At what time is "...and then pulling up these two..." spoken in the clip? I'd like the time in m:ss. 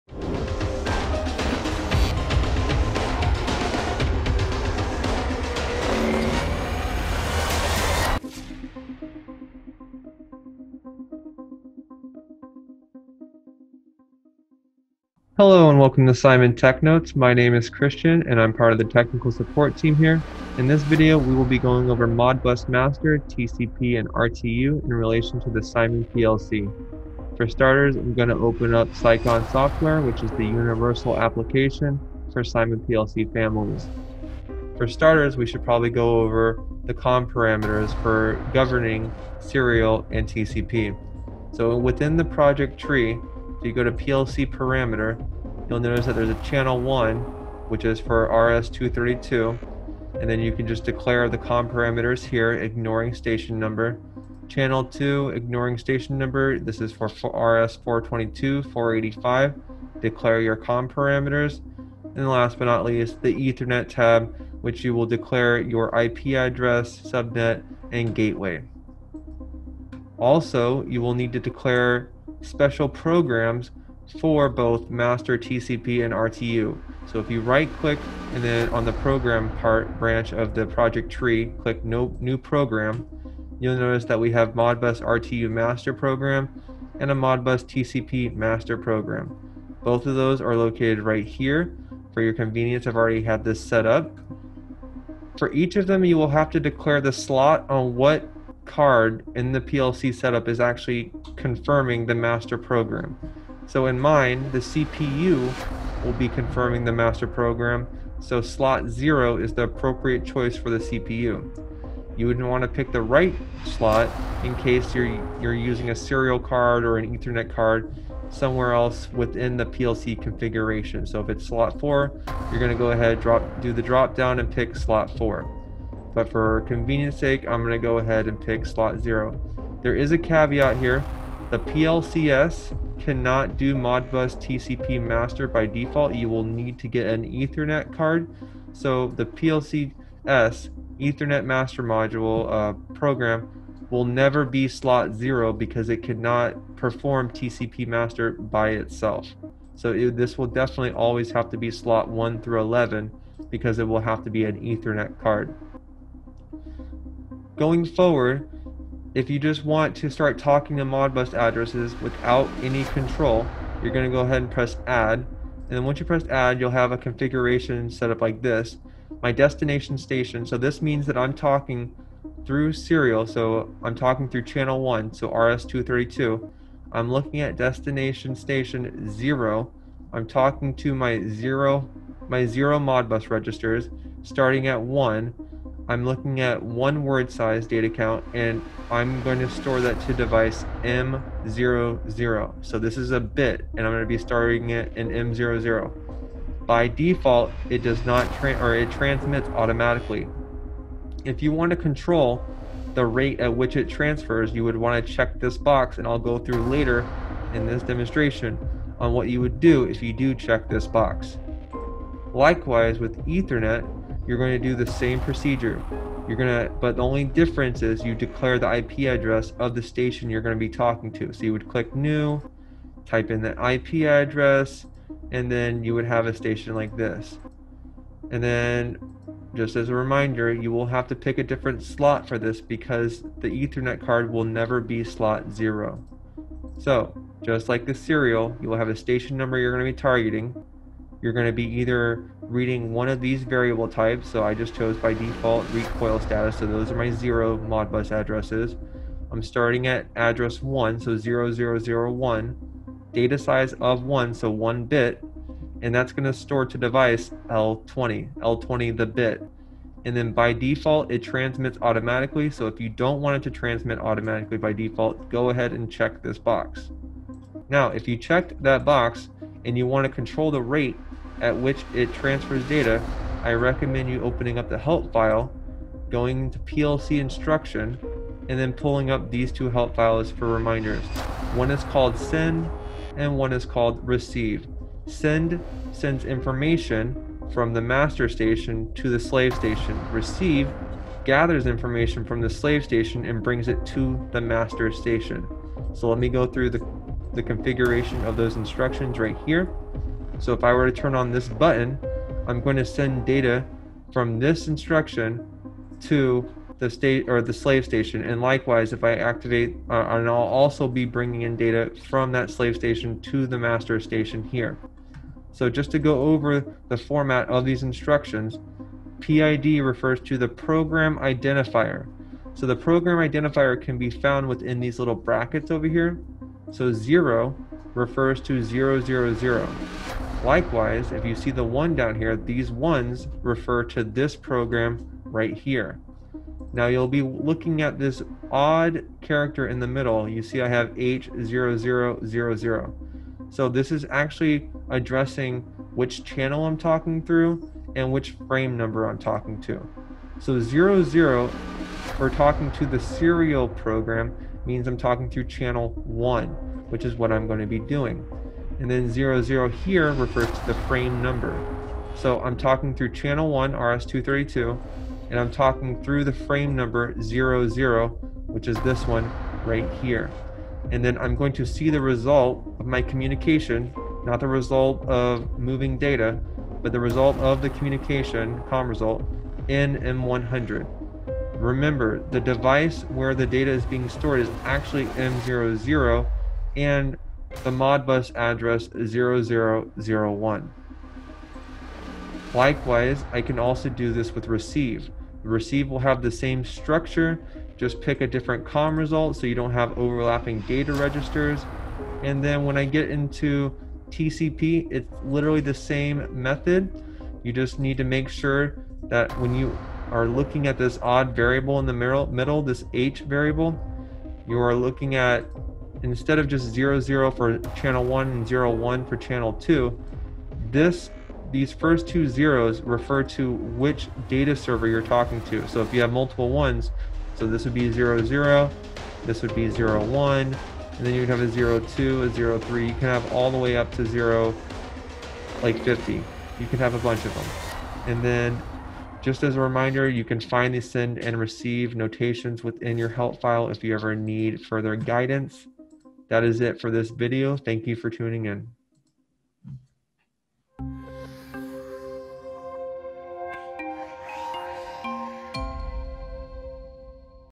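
4:38.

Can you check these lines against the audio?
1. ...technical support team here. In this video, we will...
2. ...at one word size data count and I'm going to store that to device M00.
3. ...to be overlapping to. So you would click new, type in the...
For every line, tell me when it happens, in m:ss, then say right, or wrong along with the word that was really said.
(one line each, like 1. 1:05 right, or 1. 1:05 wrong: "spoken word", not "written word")
1. 0:18 right
2. 3:06 right
3. 3:40 wrong: "talking", not "overlapping".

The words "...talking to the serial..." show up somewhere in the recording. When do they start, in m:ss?
5:52.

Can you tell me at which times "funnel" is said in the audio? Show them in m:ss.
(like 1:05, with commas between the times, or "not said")
not said.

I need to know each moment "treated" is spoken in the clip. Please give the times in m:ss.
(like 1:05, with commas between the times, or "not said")
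not said.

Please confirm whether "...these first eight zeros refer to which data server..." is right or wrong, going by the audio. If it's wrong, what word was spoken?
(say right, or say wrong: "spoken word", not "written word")
wrong: "two", not "eight".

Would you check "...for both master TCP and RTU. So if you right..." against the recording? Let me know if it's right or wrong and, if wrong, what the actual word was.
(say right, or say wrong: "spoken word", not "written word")
right.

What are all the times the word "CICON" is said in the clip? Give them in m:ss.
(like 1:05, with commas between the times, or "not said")
0:28.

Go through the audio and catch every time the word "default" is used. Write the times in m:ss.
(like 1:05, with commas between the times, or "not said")
2:15, 3:16, 4:05, 4:20, 4:24.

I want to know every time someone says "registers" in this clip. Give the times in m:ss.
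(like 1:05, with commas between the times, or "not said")
3:03, 6:40.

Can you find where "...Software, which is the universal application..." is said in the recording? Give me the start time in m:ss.
0:29.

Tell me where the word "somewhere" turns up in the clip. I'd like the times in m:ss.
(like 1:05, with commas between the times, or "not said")
1:58.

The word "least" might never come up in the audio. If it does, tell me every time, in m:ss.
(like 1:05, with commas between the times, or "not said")
1:02.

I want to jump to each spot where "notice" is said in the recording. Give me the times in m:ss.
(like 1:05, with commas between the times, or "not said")
0:45, 1:23.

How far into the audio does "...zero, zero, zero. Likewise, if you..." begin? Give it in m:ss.
5:28.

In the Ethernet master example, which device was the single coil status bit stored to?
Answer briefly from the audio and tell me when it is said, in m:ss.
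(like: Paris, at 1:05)
L20, at 4:18.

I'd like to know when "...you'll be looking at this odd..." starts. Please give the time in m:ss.
5:36.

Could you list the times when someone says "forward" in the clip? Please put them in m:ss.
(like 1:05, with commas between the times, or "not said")
2:37.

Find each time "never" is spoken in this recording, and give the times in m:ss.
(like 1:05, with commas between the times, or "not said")
2:24, 3:54.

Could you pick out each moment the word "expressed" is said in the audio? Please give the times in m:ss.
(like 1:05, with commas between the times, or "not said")
not said.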